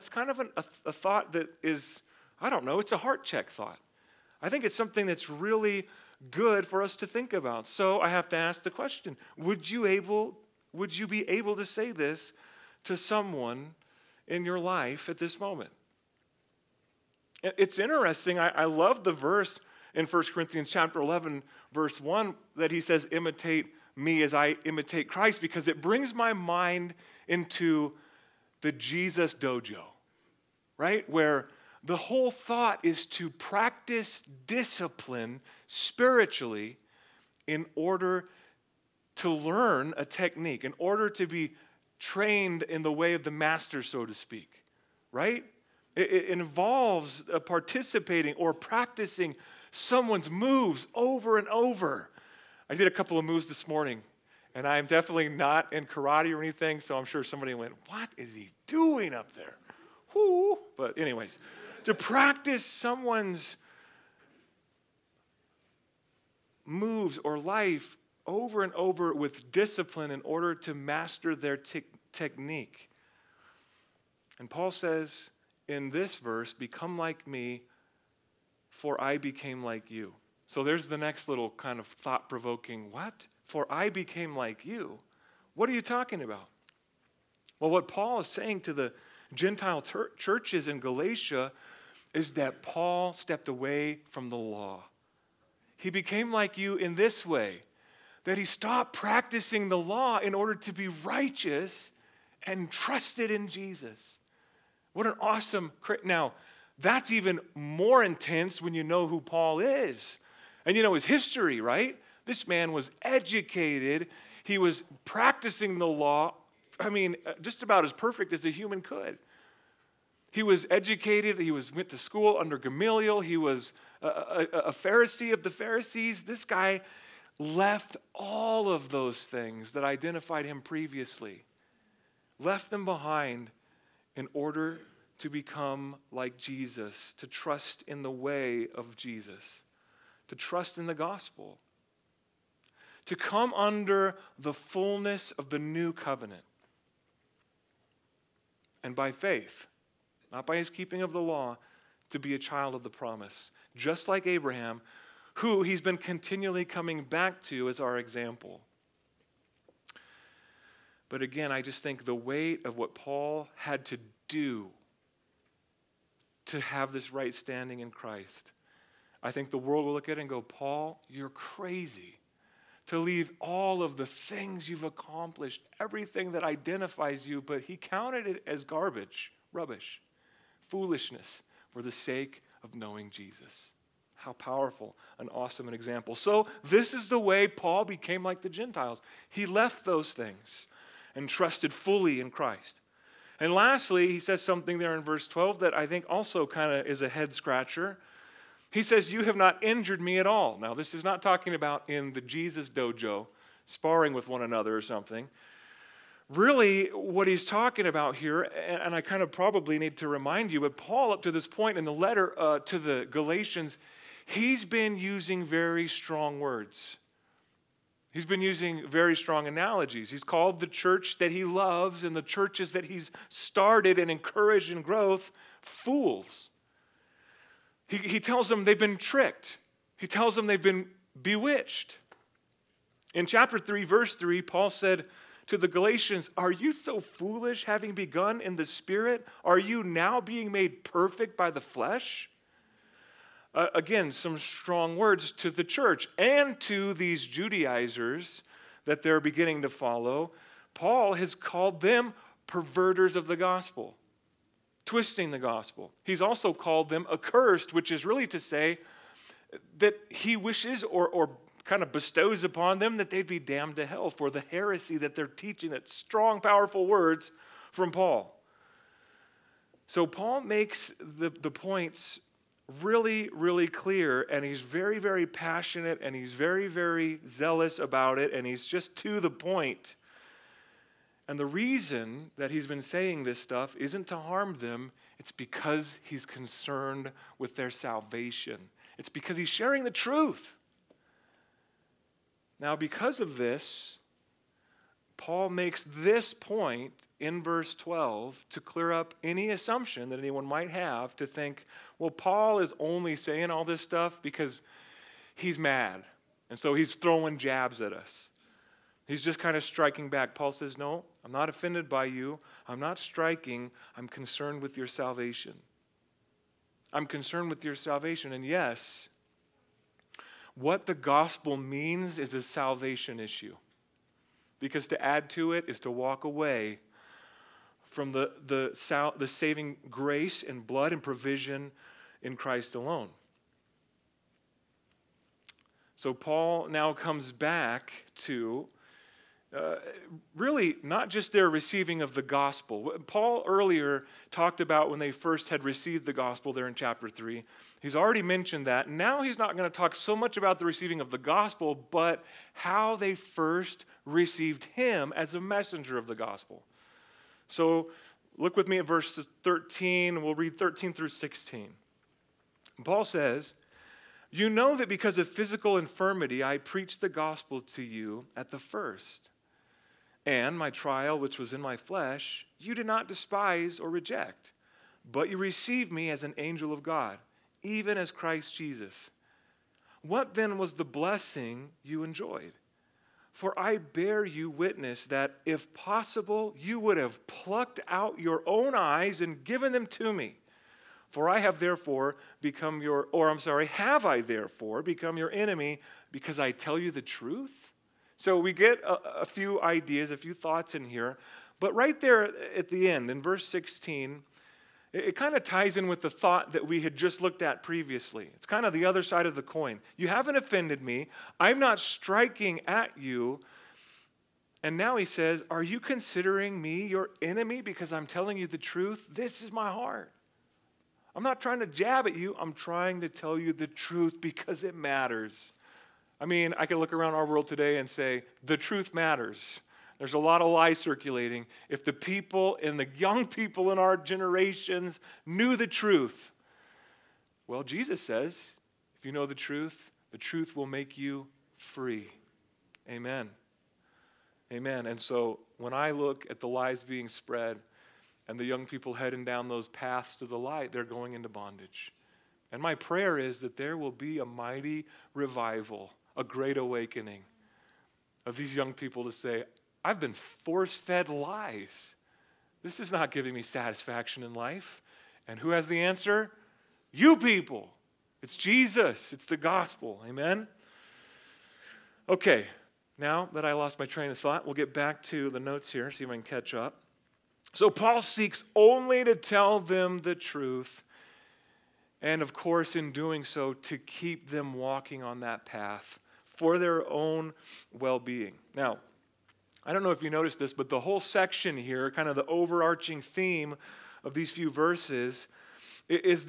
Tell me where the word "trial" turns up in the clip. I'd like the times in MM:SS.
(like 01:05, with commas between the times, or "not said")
06:10.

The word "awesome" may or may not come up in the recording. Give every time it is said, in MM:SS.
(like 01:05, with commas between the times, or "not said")
01:45, 03:05.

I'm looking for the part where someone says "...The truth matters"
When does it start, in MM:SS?
07:08.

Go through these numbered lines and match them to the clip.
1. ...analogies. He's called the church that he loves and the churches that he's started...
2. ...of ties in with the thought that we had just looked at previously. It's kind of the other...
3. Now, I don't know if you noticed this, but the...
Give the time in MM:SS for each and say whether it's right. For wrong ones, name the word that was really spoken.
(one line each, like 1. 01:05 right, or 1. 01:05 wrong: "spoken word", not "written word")
1. 03:39 right
2. 06:45 right
3. 08:08 right.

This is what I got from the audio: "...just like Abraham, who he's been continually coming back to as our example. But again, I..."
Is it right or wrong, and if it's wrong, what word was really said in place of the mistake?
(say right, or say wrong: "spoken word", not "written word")
right.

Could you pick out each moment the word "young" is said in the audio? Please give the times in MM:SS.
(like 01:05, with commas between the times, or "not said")
07:12, 07:28, 07:38.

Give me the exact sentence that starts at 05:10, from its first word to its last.
Paul says, No, I'm not offended by you.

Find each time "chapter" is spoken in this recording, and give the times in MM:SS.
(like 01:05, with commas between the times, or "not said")
00:20, 03:53, 05:46.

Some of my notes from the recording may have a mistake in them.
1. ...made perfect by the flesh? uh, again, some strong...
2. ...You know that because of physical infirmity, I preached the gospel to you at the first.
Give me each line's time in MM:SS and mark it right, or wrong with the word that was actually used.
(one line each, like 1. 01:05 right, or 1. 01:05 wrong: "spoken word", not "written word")
1. 04:00 right
2. 06:04 right.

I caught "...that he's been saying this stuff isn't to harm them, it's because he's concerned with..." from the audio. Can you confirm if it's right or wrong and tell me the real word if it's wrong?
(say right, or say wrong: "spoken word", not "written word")
right.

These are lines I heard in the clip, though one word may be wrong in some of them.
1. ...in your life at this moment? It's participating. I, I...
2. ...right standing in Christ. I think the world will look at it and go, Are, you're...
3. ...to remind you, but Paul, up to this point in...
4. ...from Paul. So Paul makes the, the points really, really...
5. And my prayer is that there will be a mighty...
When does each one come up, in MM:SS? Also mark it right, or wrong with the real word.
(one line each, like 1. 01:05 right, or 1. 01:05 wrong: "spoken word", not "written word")
1. 00:14 wrong: "interesting", not "participating"
2. 02:47 wrong: "Paul", not "Are"
3. 03:29 right
4. 04:27 right
5. 07:32 right.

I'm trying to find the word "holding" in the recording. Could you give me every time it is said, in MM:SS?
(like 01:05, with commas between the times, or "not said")
not said.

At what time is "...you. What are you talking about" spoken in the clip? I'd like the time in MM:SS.
01:24.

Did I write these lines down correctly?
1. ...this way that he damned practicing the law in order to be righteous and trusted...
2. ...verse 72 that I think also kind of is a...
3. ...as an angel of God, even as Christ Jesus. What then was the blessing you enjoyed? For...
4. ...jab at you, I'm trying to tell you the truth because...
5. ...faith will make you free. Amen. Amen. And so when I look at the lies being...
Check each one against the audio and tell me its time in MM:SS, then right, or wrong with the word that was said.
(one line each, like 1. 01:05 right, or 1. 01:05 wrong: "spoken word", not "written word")
1. 01:36 wrong: "stopped", not "damned"
2. 03:15 wrong: "12", not "72"
3. 06:16 right
4. 07:01 right
5. 07:20 wrong: "truth", not "faith".